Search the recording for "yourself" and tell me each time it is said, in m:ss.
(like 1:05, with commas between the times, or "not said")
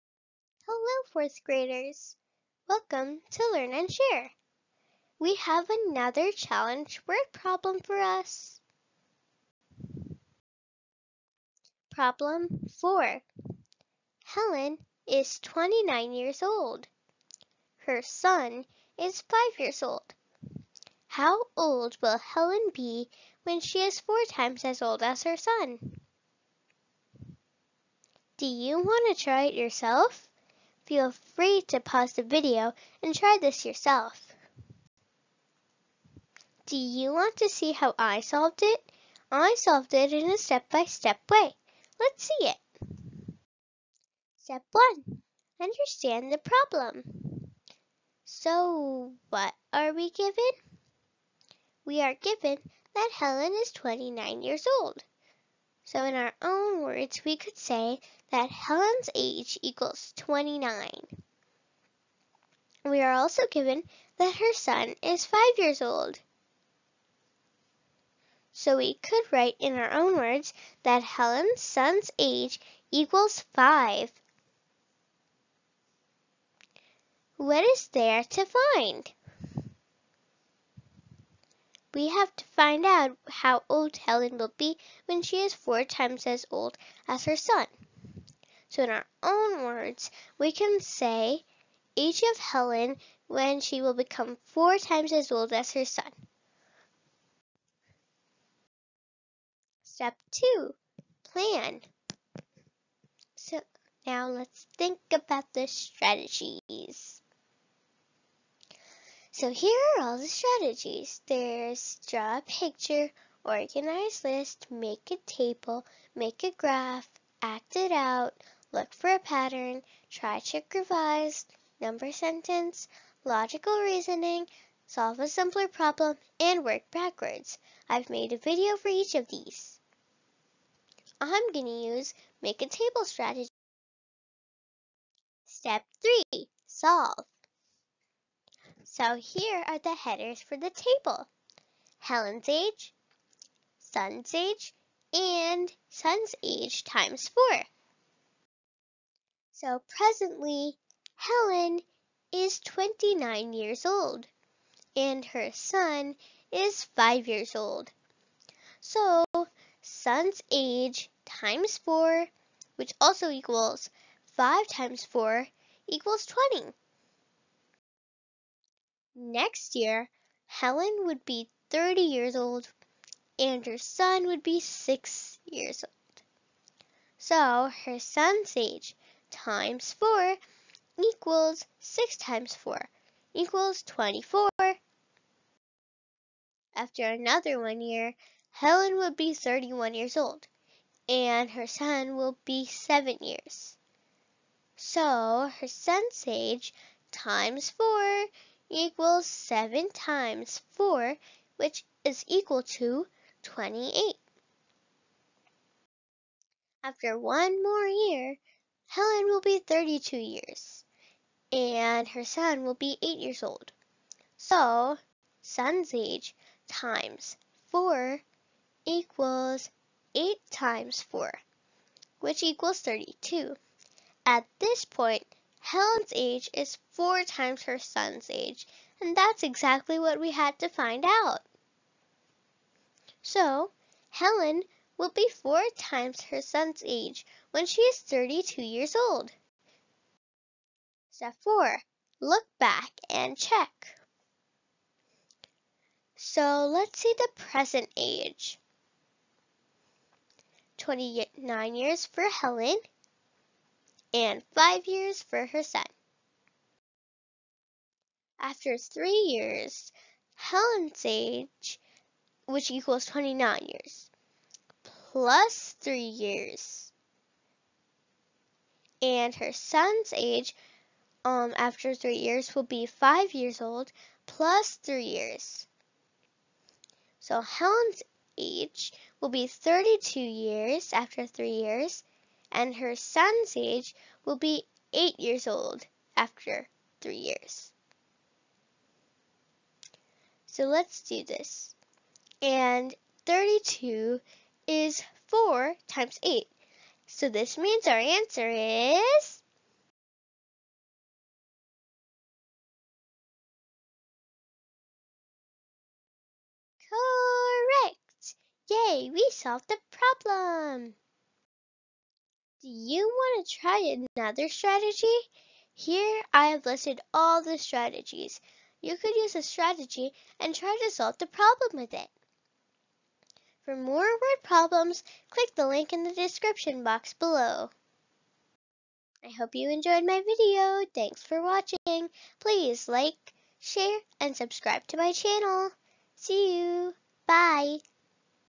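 0:29, 0:33.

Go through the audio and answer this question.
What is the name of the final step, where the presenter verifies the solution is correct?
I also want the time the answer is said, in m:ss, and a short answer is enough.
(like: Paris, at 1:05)
Look back and check, at 4:02.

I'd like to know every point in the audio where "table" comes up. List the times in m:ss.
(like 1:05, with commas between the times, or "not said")
1:55, 2:12, 2:20.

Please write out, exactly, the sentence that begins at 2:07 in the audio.
I've made a video for each of these.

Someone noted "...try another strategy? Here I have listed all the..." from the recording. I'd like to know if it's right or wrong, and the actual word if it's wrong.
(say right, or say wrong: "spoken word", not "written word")
right.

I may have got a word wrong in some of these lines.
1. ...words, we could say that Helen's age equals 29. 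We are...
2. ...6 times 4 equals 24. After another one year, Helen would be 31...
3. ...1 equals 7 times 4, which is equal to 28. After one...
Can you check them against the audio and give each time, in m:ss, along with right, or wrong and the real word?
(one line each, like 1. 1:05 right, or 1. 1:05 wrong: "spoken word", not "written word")
1. 0:56 right
2. 3:01 right
3. 3:17 wrong: "4", not "1".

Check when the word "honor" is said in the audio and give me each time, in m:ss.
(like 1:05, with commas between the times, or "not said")
not said.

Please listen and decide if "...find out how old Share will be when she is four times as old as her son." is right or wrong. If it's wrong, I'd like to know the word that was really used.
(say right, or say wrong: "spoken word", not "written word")
wrong: "Helen", not "Share".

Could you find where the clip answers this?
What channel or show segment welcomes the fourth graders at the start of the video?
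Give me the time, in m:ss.
0:03.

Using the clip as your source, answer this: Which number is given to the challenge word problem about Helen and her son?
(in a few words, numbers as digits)
4.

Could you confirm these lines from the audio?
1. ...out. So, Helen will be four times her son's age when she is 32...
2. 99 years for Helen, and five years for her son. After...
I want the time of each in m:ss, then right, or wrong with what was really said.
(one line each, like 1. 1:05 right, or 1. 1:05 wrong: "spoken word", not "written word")
1. 3:51 right
2. 4:10 wrong: "29", not "99".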